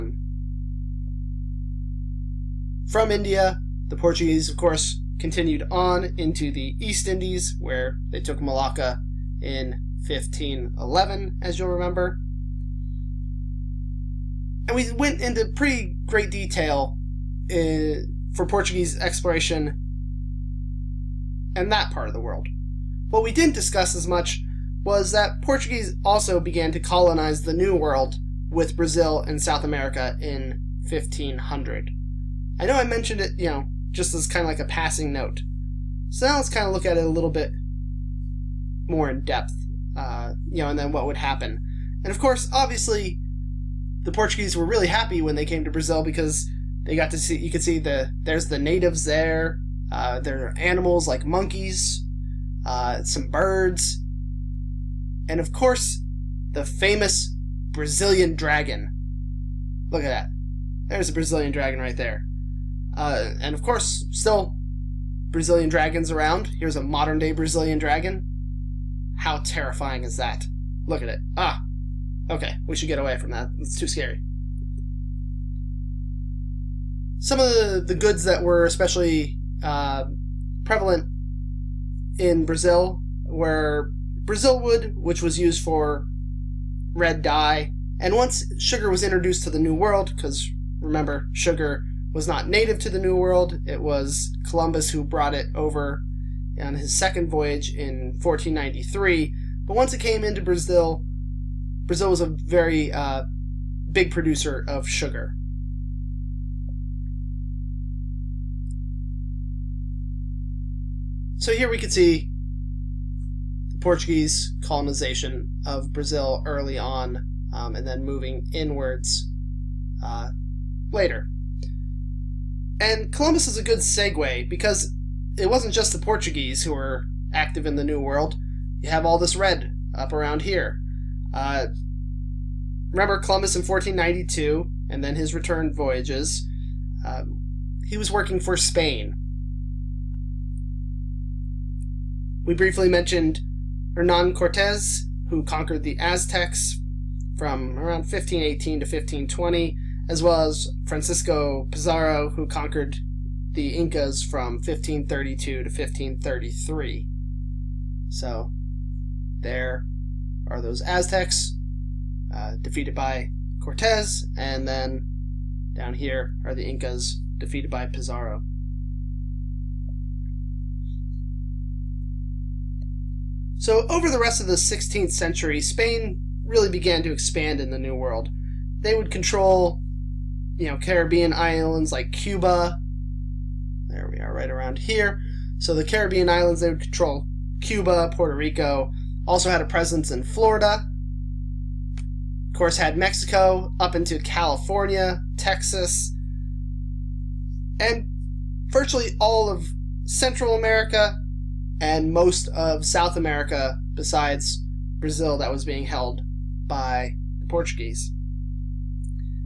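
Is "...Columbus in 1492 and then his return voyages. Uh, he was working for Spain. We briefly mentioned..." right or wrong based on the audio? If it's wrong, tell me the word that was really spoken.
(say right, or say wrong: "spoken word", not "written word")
right.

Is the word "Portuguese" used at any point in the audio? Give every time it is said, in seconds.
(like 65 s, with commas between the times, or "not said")
3 s, 18 s, 25 s, 44 s, 113 s, 125 s, 207 s.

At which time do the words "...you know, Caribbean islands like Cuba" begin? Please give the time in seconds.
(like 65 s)
180 s.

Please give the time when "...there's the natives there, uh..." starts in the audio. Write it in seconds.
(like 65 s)
48 s.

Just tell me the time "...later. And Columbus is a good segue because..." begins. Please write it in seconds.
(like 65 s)
120 s.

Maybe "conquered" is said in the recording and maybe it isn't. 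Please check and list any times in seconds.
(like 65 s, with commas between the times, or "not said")
145 s, 152 s.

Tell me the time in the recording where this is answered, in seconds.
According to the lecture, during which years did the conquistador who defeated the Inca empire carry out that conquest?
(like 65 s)
154 s.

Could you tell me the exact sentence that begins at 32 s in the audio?
I know I mentioned it, you know, just as kind of like a passing note.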